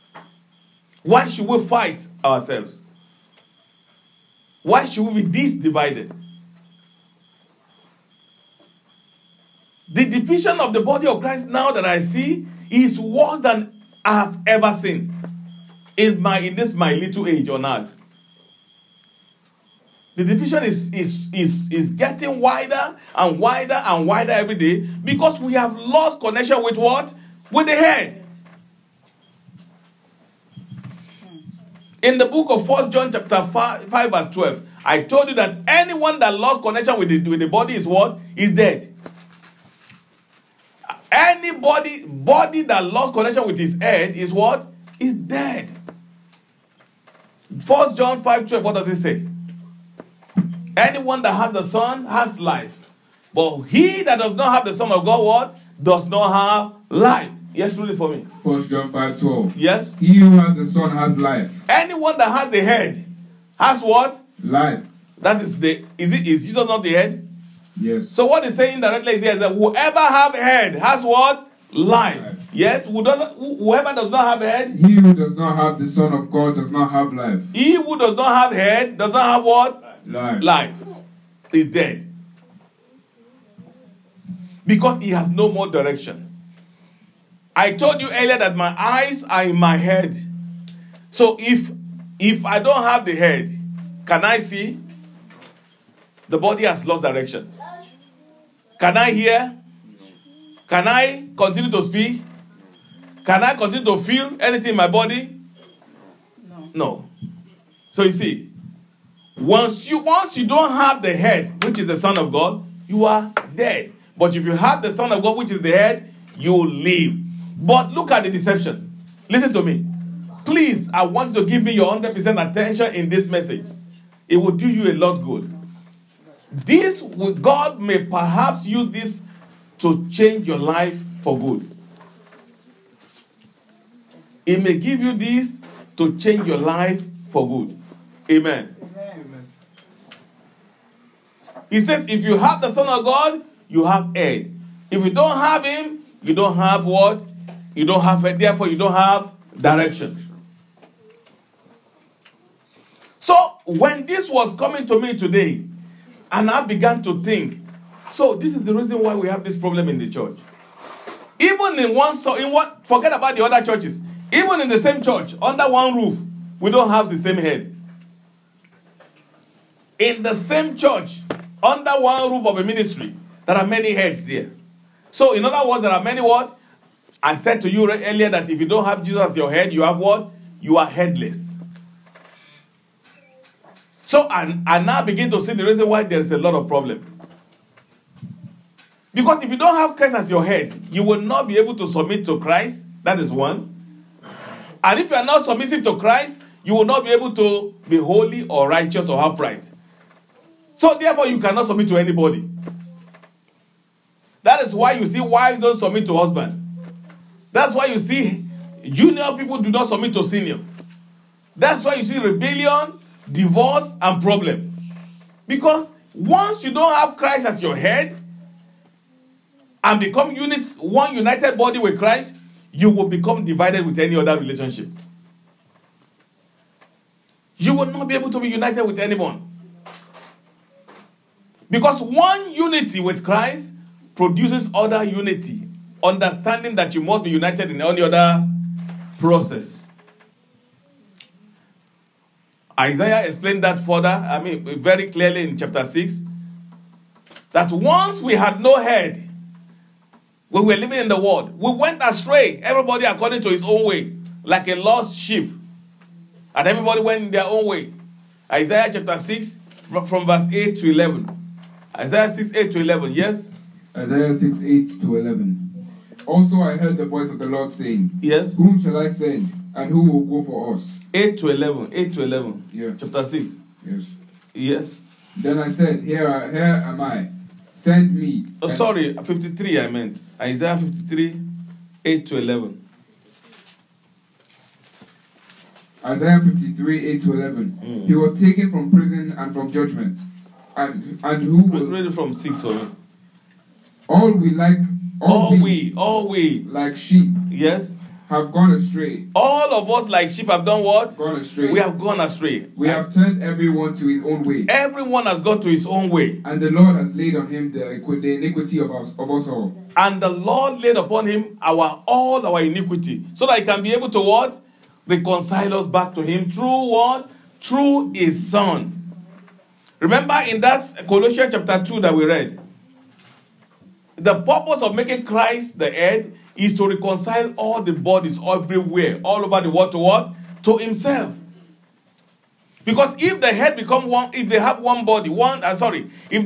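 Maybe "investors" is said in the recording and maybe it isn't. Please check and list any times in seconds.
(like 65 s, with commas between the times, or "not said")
not said.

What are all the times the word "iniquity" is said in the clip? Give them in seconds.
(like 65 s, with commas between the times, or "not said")
308 s, 312 s.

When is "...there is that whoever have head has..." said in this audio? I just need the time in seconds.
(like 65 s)
69 s.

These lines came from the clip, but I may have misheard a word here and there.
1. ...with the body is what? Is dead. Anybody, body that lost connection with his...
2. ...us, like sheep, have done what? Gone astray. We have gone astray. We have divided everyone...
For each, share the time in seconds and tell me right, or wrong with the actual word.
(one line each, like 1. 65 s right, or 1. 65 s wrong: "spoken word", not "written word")
1. 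37 s right
2. 299 s wrong: "turned", not "divided".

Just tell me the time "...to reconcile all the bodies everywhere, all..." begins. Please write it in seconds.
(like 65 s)
326 s.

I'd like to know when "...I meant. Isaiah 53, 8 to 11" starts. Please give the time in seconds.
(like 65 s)
279 s.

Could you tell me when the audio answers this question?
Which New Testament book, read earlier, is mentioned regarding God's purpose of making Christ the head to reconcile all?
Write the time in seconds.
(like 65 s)
321 s.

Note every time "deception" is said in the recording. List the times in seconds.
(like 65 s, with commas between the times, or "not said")
118 s.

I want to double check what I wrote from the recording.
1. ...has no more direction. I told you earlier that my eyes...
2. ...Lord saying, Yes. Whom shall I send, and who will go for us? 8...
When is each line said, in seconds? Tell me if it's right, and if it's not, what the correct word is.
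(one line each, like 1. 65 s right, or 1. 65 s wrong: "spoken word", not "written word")
1. 85 s right
2. 267 s right.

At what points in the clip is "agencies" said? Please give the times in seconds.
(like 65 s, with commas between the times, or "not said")
not said.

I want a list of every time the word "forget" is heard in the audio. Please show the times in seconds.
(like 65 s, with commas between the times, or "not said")
162 s.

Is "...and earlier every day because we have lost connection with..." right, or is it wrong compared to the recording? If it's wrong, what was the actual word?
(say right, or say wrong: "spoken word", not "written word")
wrong: "wider", not "earlier".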